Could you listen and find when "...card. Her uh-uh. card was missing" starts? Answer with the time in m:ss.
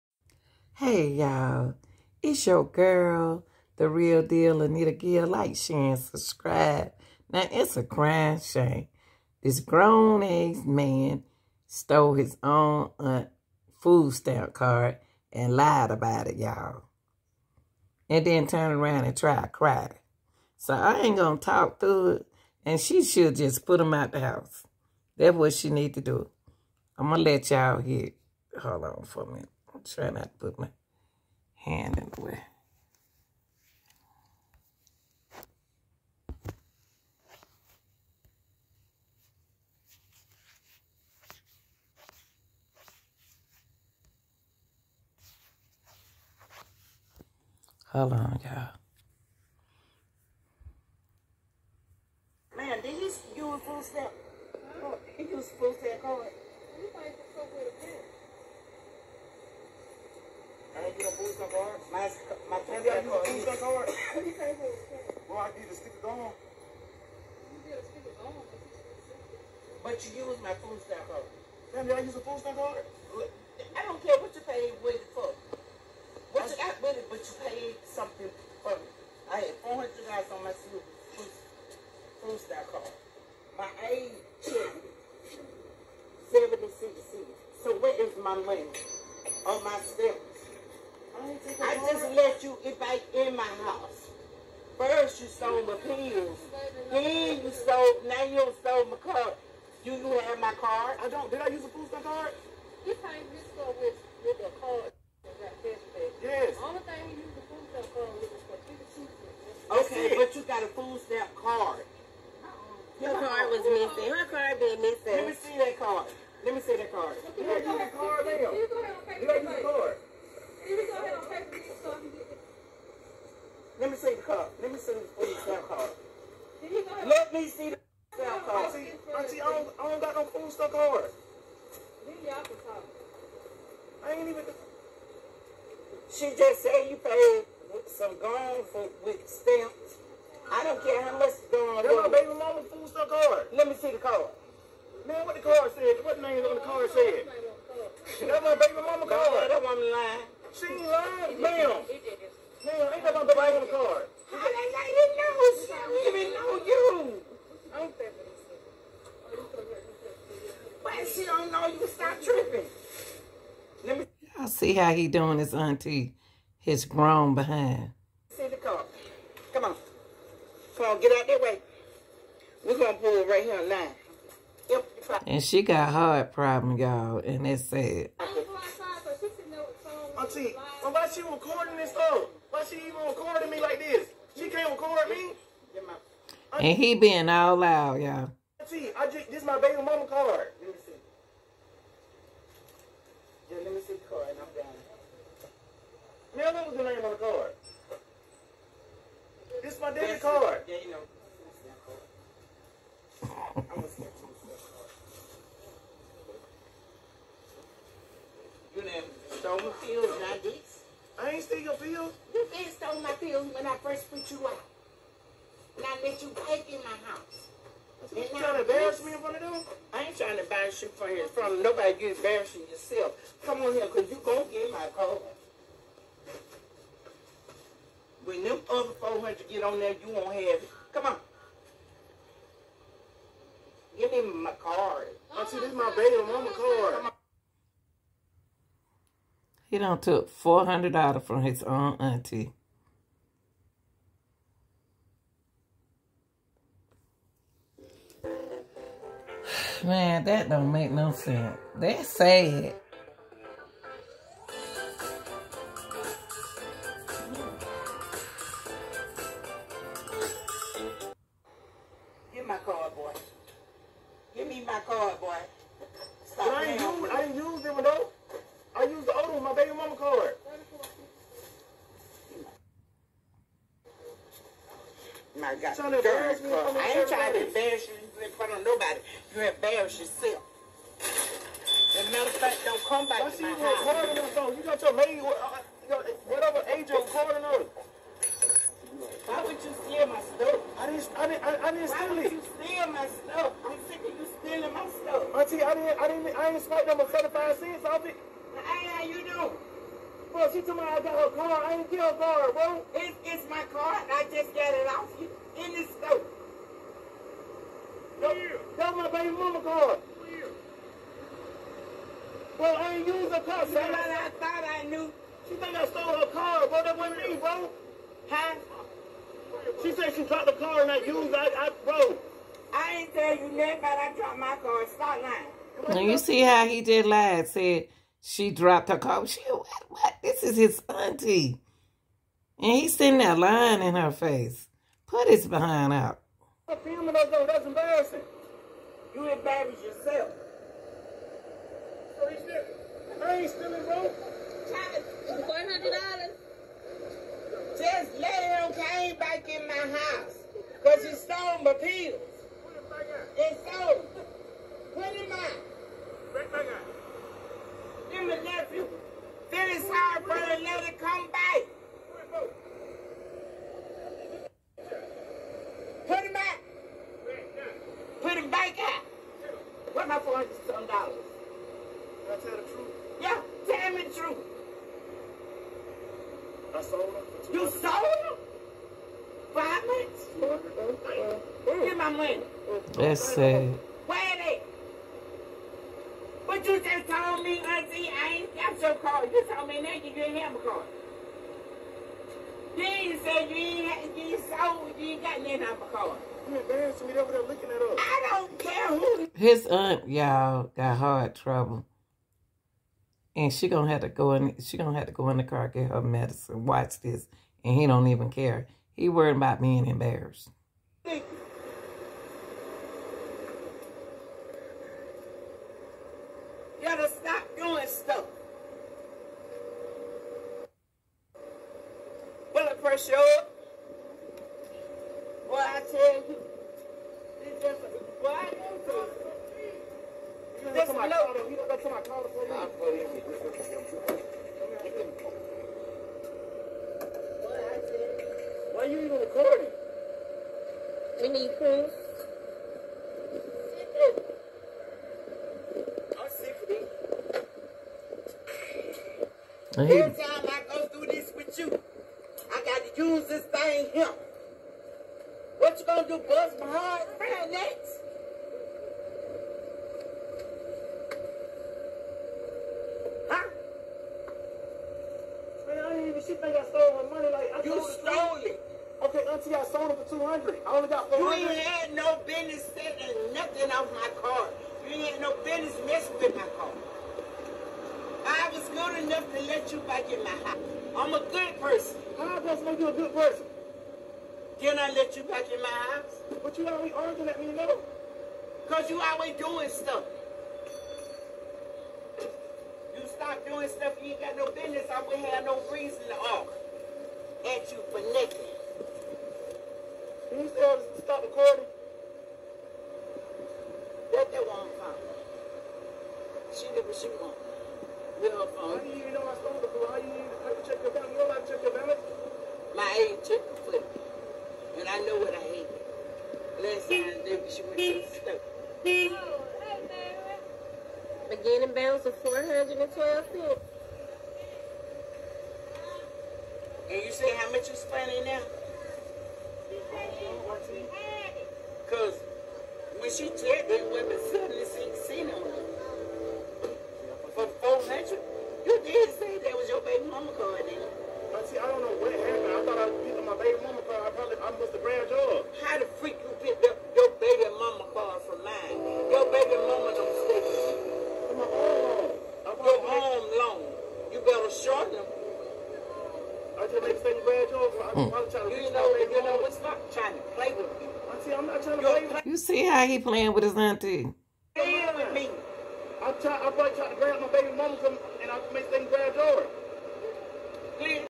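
1:51.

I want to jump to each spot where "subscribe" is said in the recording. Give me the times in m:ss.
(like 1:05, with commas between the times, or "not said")
0:05.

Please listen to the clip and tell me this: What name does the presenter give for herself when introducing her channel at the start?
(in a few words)
Anita Gill.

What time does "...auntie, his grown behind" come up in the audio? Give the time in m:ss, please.
2:45.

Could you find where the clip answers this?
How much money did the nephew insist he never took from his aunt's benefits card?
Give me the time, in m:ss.
4:57.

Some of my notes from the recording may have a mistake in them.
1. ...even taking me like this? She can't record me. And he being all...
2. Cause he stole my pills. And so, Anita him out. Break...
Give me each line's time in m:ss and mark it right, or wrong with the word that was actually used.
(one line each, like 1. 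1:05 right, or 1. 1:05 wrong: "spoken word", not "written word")
1. 3:02 wrong: "recording", not "taking"
2. 5:50 wrong: "Put", not "Anita".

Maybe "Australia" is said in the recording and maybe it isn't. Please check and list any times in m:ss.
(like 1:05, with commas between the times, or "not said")
not said.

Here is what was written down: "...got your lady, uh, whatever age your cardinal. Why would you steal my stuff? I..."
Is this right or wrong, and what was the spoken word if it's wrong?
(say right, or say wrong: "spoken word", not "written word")
right.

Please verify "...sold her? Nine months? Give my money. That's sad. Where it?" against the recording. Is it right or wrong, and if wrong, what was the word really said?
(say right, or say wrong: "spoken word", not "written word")
wrong: "Five", not "Nine".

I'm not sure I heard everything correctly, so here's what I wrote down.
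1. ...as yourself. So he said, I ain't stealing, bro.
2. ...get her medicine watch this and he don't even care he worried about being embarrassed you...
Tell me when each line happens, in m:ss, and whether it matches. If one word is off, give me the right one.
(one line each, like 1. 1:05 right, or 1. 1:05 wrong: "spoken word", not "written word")
1. 5:39 right
2. 6:45 right.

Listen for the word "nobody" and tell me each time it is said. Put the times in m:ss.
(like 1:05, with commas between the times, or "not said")
3:41, 4:38.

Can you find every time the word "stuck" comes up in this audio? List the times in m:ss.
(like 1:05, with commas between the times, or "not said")
2:10, 2:22.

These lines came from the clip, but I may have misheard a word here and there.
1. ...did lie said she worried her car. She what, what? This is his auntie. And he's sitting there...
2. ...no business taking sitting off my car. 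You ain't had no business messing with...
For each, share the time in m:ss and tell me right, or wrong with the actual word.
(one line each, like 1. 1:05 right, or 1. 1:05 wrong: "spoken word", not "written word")
1. 5:26 wrong: "dropped", not "worried"
2. 7:51 wrong: "nothing", not "sitting".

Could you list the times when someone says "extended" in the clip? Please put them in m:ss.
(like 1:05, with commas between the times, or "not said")
not said.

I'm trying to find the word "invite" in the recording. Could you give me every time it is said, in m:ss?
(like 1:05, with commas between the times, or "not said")
1:32.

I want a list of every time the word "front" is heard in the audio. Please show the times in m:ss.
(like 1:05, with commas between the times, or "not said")
3:39, 4:38.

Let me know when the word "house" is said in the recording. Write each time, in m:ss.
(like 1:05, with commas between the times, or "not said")
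0:24, 1:33, 3:37, 4:43, 5:49, 8:00, 8:05.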